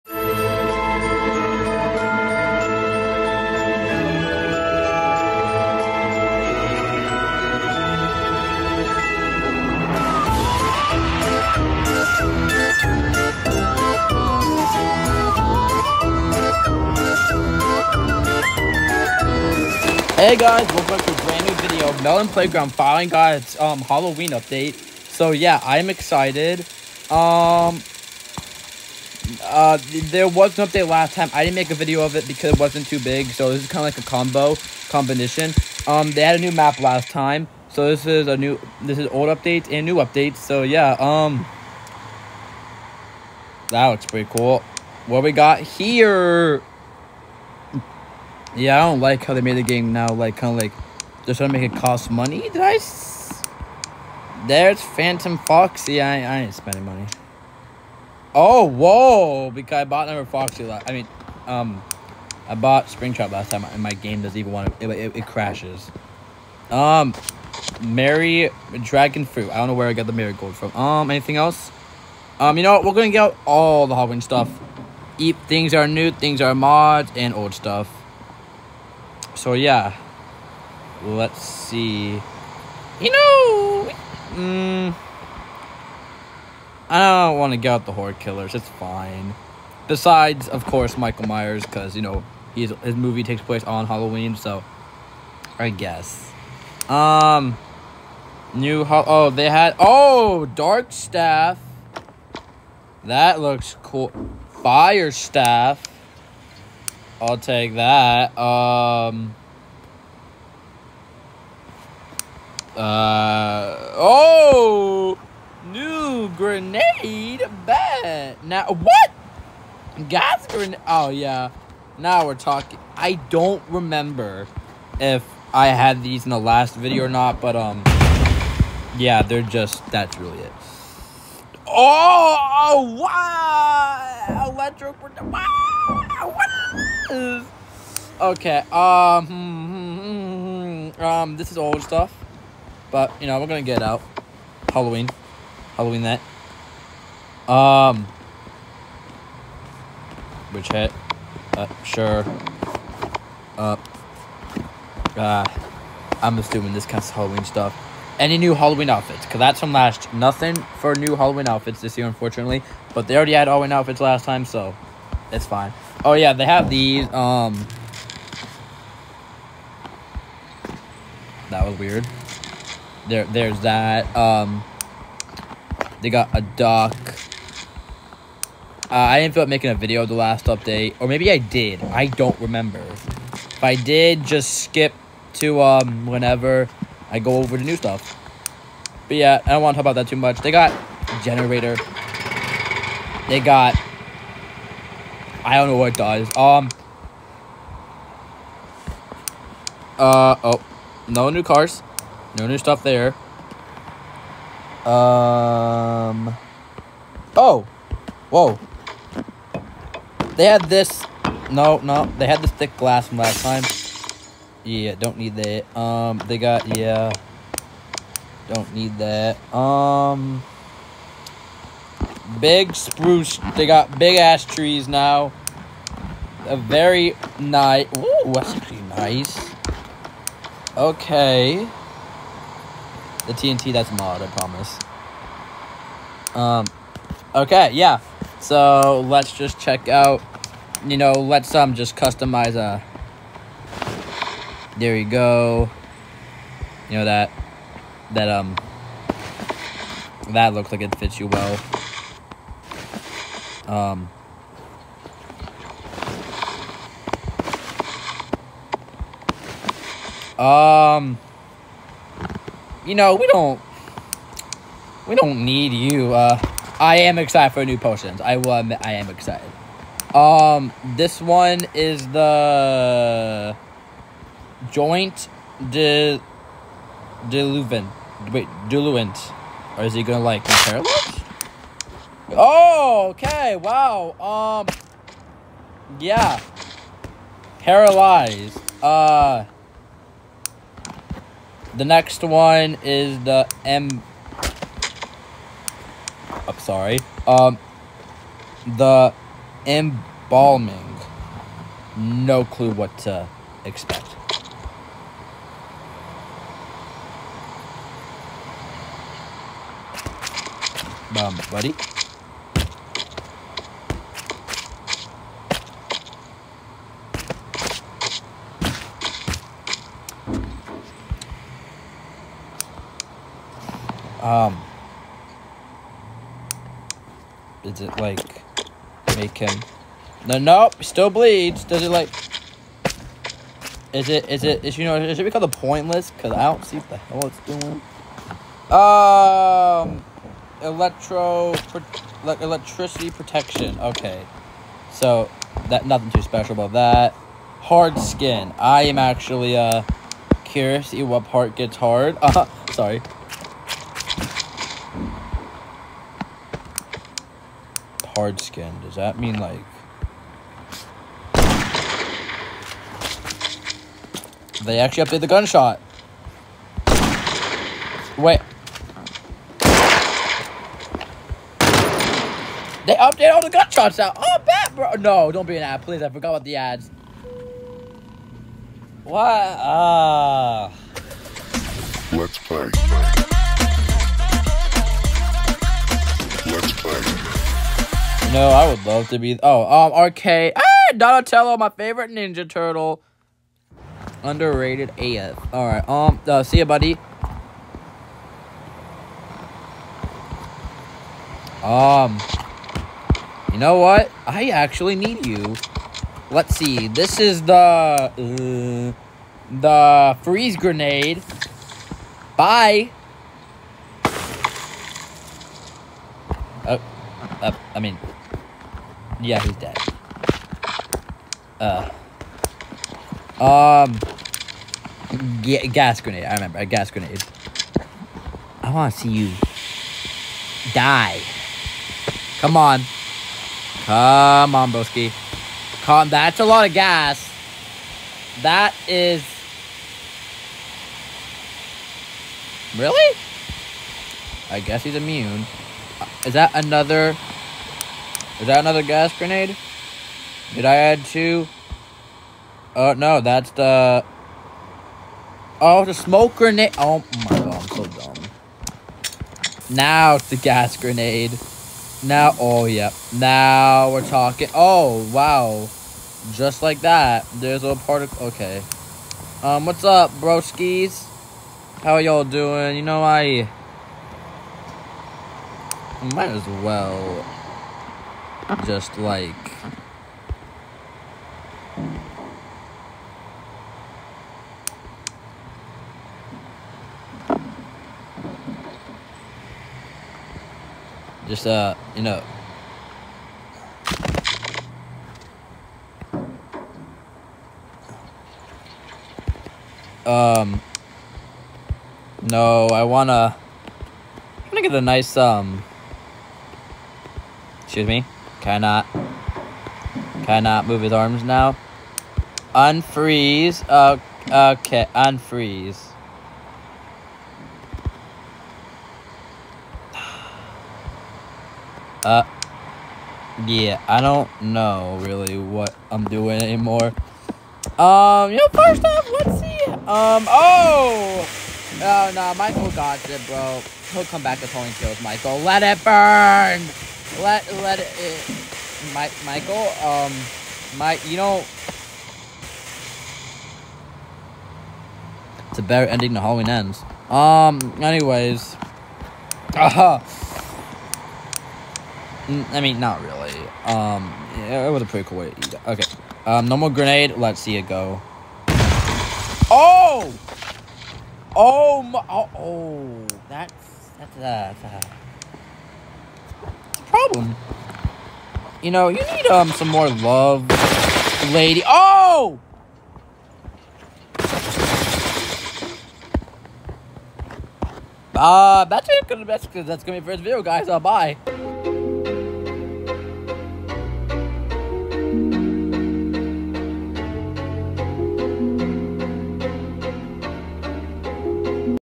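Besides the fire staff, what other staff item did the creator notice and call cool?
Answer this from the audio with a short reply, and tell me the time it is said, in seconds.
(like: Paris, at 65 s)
Dark staff, at 100 s.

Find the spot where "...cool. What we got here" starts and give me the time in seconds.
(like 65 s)
44 s.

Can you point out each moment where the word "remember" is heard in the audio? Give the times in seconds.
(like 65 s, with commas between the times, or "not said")
123 s, 182 s, 426 s.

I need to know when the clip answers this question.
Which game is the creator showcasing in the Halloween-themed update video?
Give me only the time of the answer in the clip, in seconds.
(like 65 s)
22 s.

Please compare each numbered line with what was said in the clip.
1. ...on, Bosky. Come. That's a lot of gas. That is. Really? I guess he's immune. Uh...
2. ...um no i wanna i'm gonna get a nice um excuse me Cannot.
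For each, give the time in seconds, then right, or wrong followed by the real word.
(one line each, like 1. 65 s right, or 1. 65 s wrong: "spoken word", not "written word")
1. 434 s right
2. 500 s right.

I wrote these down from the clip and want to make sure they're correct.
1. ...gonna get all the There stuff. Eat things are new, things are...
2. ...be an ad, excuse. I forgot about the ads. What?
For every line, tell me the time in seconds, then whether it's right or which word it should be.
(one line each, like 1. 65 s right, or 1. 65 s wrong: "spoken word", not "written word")
1. 72 s wrong: "Halloween", not "There"
2. 375 s wrong: "please", not "excuse".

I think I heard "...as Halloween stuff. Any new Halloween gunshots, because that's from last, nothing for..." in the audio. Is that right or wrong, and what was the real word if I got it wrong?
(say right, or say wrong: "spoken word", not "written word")
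wrong: "outfits", not "gunshots".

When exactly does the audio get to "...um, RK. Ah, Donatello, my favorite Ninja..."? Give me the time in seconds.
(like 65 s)
389 s.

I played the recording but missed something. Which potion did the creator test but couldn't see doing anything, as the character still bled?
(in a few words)
Embalming.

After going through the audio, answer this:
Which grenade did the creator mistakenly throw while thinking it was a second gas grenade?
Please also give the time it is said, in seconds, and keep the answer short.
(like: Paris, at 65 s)
Smoke grenade, at 455 s.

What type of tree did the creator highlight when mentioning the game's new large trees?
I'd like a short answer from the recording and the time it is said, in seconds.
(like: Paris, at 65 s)
Big spruce, at 222 s.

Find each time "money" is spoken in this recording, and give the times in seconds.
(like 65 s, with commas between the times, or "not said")
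52 s, 56 s.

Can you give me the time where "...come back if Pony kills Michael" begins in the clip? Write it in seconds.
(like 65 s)
534 s.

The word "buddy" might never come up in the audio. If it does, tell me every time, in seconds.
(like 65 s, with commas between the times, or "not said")
311 s, 396 s.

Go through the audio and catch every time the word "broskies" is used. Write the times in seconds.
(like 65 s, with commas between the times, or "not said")
470 s.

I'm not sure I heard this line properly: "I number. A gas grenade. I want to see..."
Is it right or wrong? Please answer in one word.
wrong.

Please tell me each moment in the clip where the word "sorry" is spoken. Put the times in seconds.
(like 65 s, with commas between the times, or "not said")
296 s, 352 s.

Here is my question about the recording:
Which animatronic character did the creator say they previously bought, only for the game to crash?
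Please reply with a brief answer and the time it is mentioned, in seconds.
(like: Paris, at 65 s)
Springtrap, at 62 s.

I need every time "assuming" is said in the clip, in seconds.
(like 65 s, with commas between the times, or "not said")
156 s.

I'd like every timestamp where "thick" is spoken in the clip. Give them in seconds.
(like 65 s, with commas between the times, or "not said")
212 s.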